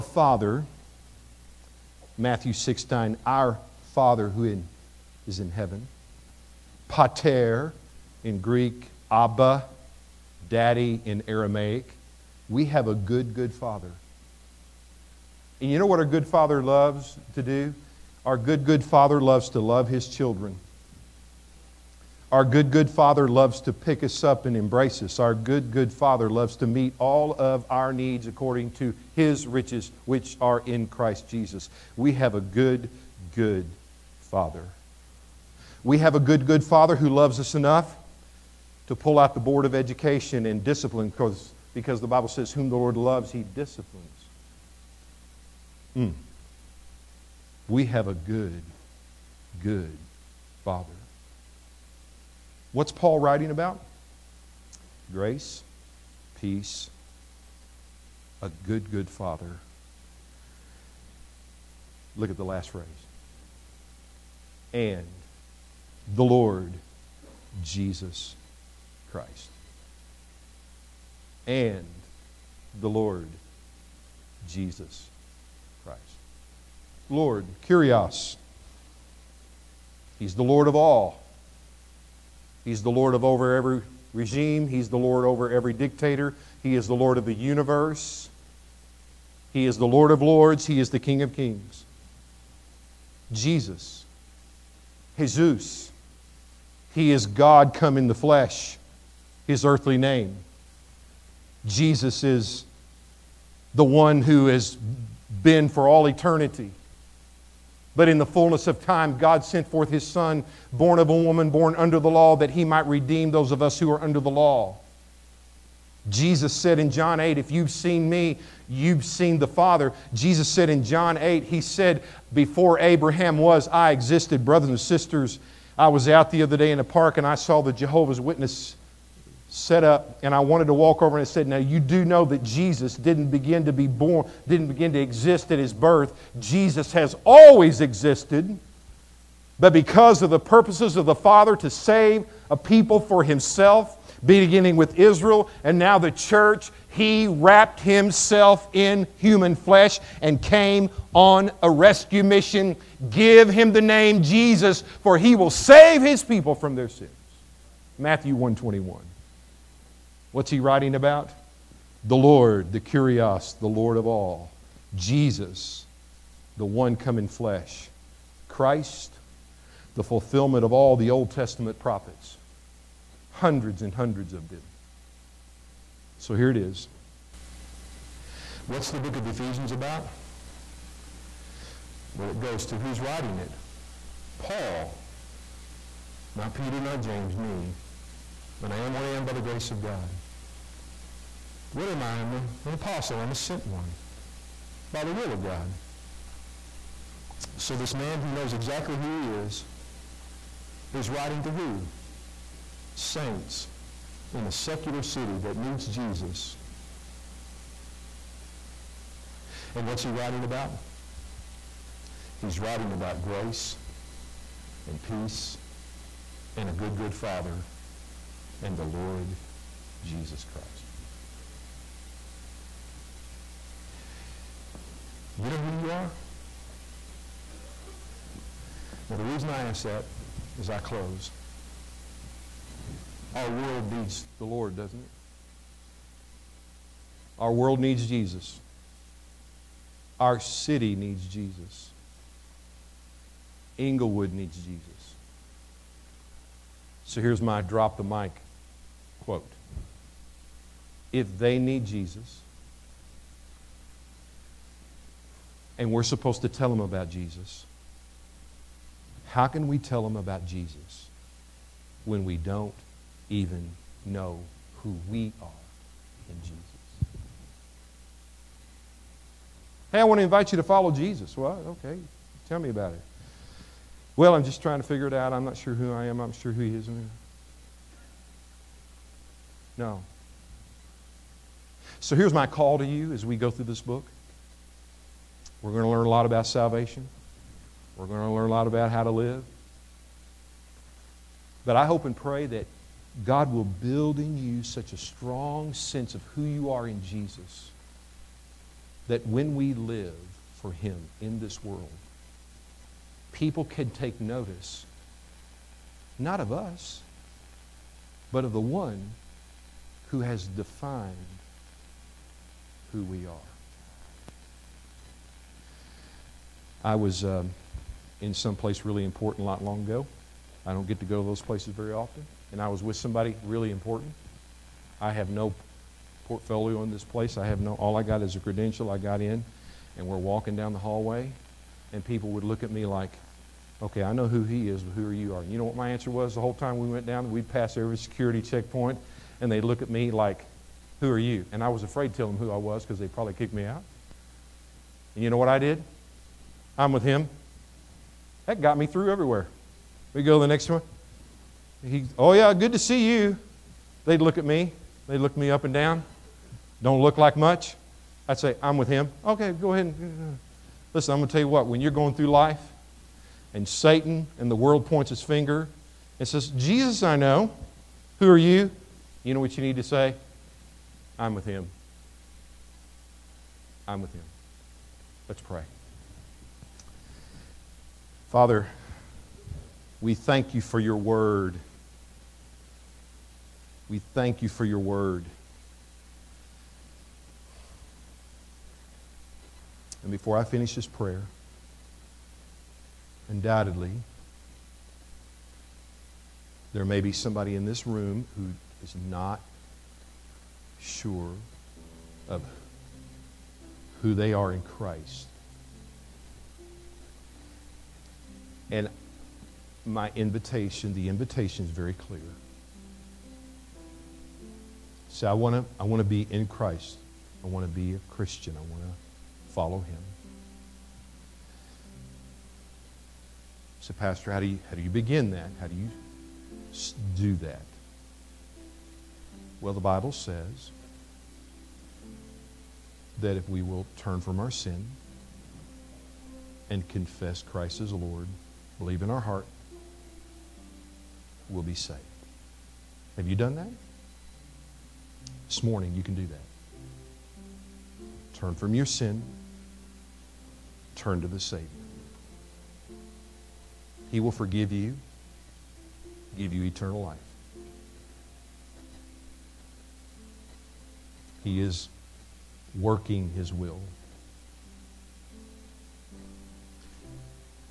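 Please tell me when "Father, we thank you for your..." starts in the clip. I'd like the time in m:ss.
6:18.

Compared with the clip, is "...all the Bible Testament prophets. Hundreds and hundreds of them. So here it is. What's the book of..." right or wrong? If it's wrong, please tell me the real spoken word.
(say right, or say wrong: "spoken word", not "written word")
wrong: "Old", not "Bible".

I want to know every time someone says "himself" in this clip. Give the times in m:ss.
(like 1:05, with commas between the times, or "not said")
2:23, 2:27.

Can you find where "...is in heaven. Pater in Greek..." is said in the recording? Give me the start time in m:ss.
0:05.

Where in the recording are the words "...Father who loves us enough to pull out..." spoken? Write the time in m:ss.
0:36.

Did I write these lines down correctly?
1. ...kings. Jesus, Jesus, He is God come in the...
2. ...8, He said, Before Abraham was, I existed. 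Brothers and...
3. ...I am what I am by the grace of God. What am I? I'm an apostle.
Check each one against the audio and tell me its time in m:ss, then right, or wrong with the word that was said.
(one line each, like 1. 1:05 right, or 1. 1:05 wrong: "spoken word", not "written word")
1. 1:31 right
2. 2:01 right
3. 3:08 right.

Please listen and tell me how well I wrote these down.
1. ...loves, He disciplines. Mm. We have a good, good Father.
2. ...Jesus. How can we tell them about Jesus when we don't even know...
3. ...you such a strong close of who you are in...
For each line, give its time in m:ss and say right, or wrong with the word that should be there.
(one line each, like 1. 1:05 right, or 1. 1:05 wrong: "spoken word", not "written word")
1. 0:42 right
2. 4:17 right
3. 4:54 wrong: "sense", not "close".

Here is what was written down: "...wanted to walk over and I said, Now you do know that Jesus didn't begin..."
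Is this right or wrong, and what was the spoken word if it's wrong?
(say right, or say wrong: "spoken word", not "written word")
right.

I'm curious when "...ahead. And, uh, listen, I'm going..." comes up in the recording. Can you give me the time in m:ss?
5:59.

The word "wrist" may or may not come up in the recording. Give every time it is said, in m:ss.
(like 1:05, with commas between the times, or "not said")
not said.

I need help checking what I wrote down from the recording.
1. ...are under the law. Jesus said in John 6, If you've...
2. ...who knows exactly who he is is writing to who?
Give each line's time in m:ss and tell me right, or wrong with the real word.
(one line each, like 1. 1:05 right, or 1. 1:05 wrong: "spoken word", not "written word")
1. 1:53 wrong: "8", not "6"
2. 3:18 right.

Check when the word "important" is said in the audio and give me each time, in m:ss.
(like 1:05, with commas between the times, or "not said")
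5:19, 5:23.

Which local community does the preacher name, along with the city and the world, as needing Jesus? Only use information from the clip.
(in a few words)
Inglewood.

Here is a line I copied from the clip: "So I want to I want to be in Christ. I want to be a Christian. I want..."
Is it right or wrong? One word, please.
right.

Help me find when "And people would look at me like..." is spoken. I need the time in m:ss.
5:31.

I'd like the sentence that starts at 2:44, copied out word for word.
Jesus, the one come in flesh.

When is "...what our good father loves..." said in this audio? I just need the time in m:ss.
0:15.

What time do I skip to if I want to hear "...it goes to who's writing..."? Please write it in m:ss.
3:02.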